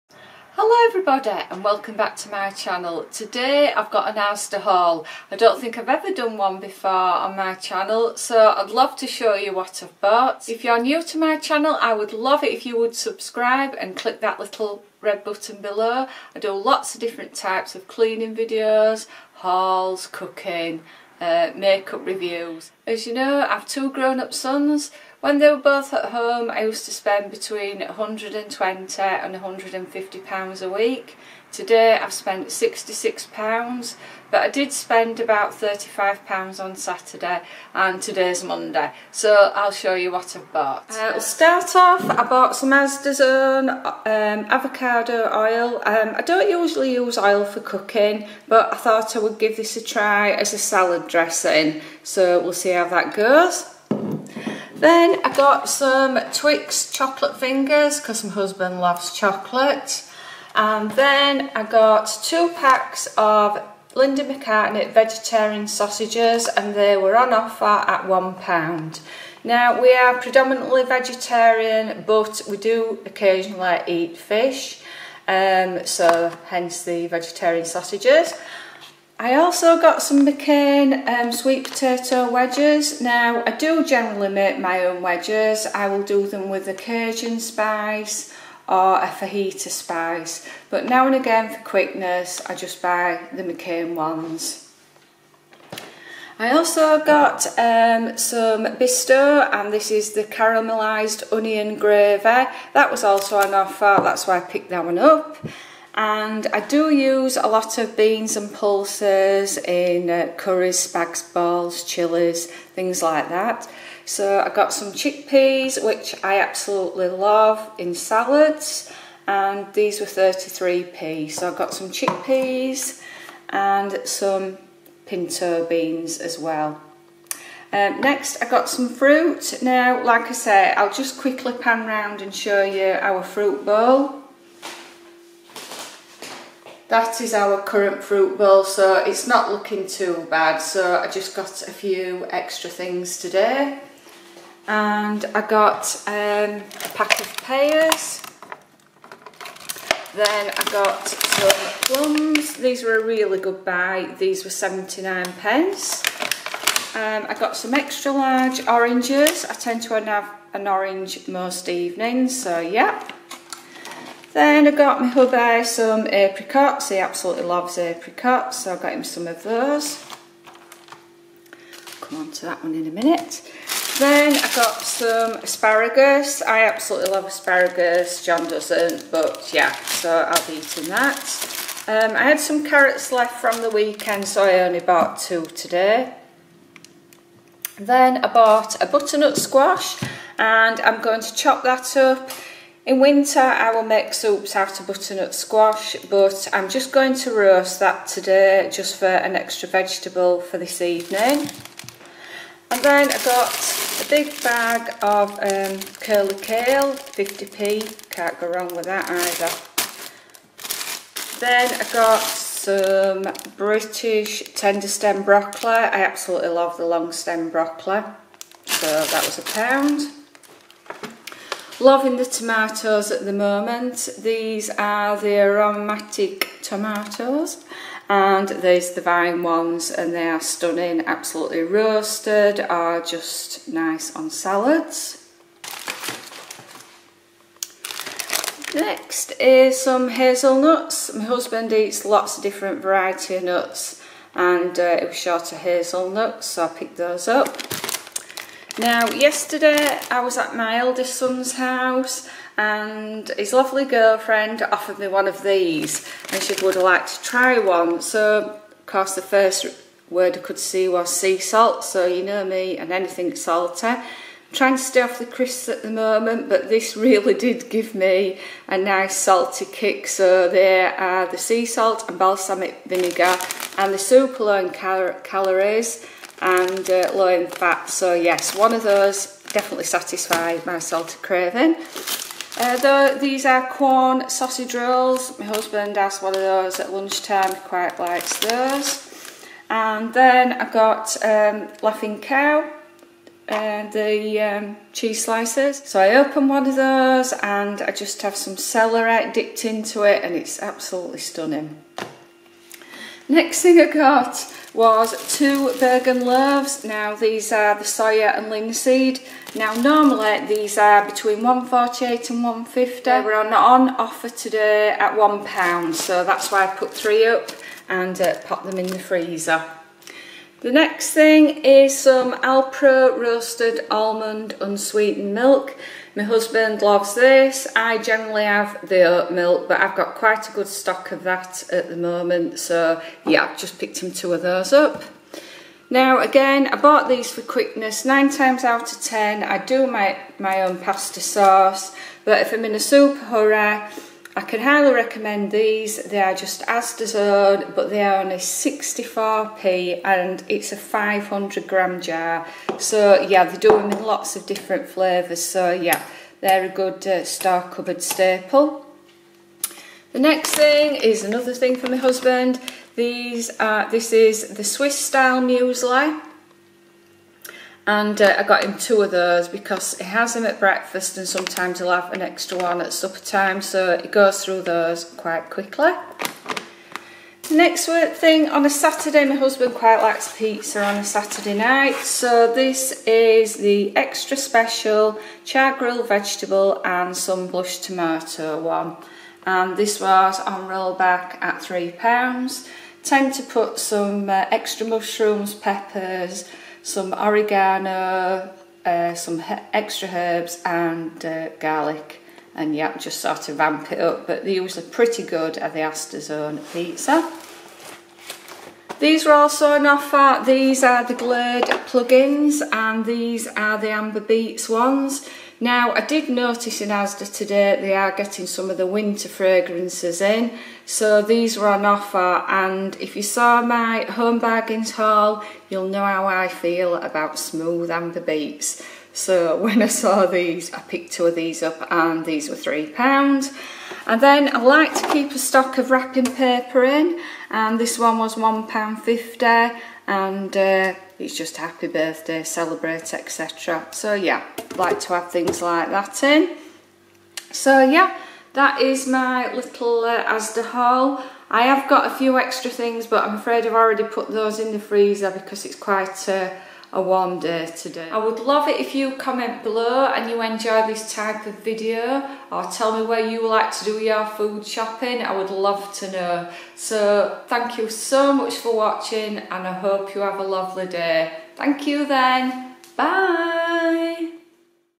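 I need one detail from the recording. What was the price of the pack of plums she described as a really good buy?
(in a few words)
79p.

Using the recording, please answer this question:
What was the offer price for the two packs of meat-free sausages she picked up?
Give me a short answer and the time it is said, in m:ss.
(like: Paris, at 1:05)
£1, at 1:08.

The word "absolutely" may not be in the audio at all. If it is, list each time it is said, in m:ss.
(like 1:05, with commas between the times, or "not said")
1:56, 2:46, 2:56, 3:36, 3:51, 5:00.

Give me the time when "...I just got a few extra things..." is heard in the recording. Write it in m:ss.
2:20.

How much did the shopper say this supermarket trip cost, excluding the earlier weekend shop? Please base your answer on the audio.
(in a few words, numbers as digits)
£66.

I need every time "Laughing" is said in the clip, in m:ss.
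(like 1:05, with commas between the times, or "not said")
4:51.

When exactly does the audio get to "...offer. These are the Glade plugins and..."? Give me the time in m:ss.
6:49.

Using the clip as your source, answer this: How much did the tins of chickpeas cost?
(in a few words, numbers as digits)
33p.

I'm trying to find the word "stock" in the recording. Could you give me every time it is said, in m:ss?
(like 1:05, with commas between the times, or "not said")
5:30, 7:15.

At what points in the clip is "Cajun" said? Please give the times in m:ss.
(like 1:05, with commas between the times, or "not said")
1:26.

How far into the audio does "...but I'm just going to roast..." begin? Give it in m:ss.
3:16.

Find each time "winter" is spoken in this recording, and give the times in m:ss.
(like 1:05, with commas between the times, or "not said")
3:12, 6:58.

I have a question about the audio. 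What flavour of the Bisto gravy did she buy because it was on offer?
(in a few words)
caramelised onion.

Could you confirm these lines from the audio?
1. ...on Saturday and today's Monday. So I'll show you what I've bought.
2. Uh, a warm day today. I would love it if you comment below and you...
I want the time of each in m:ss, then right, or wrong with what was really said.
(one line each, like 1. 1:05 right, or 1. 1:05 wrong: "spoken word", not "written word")
1. 0:36 right
2. 7:36 right.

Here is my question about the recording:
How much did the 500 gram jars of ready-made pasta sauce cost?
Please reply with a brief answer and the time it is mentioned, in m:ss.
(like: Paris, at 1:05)
64p, at 5:48.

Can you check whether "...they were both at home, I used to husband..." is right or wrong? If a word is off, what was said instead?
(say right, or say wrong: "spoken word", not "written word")
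wrong: "spend", not "husband".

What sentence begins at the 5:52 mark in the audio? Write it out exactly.
So yeah, they do them in lots of different flavours.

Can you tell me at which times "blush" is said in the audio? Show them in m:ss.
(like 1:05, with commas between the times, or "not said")
6:27.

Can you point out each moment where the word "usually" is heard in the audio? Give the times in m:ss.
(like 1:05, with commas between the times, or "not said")
0:46, 6:44.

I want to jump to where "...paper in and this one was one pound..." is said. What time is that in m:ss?
7:16.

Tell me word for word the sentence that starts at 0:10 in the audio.
If you're new to my channel I would love it if you would subscribe and click that little red button below.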